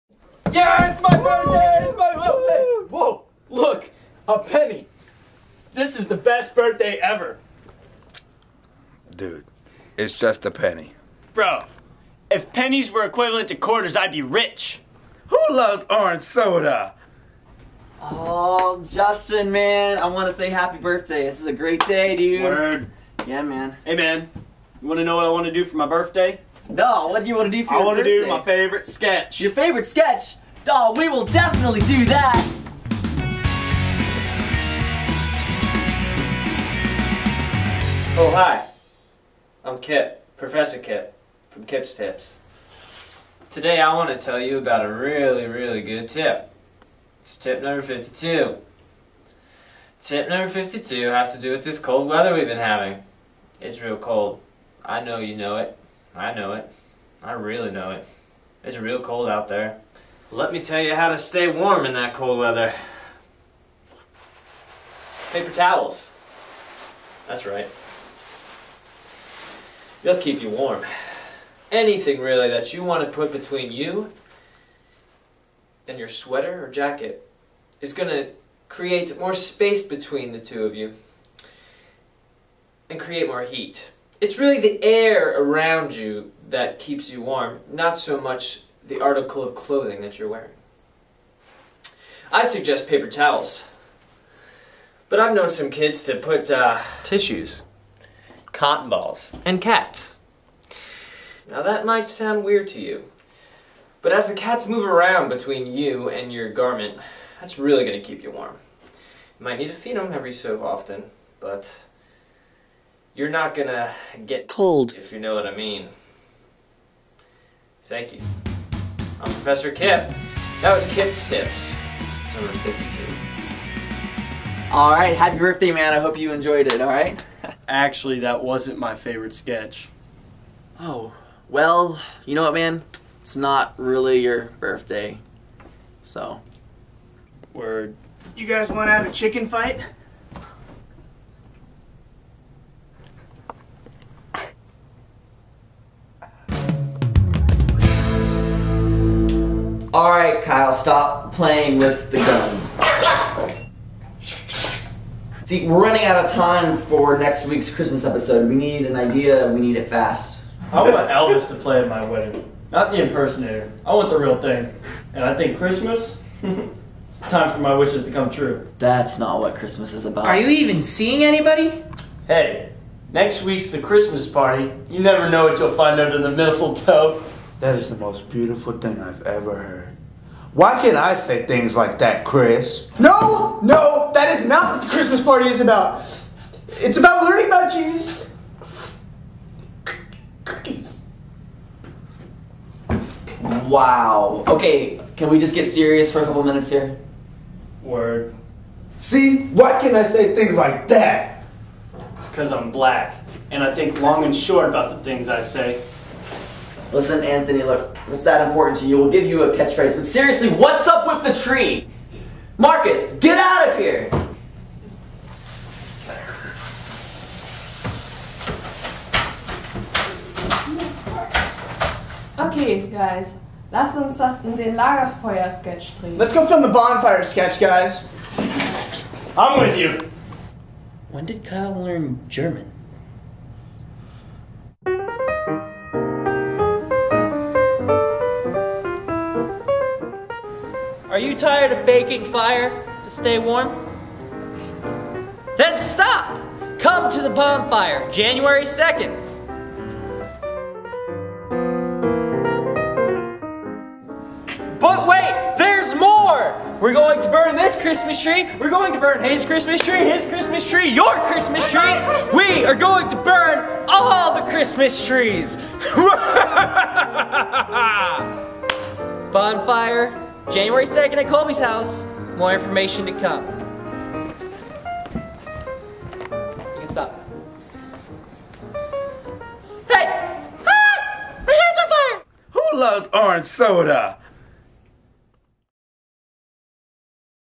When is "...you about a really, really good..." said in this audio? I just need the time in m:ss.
0:44.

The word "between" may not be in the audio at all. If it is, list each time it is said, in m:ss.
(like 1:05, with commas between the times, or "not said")
1:13, 1:19, 1:45.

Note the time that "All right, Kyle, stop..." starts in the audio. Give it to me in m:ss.
2:29.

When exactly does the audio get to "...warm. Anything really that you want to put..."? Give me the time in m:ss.
1:10.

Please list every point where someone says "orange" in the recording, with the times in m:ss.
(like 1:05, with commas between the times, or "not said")
0:15, 4:43.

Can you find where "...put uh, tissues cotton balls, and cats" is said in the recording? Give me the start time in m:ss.
1:36.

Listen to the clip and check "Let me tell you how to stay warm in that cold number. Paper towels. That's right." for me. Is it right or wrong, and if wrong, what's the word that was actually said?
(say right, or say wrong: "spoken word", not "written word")
wrong: "weather", not "number".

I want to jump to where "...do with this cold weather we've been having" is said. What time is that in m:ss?
0:51.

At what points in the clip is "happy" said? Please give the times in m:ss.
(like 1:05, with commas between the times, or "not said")
0:20, 2:05.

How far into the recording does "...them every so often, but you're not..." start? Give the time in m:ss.
1:49.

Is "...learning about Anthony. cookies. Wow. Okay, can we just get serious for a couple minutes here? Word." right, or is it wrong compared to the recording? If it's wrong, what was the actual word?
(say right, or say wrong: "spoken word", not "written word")
wrong: "Jesus", not "Anthony".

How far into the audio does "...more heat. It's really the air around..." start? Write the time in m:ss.
1:23.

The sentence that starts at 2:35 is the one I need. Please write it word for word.
See, we're running out of time for next week's Christmas episode.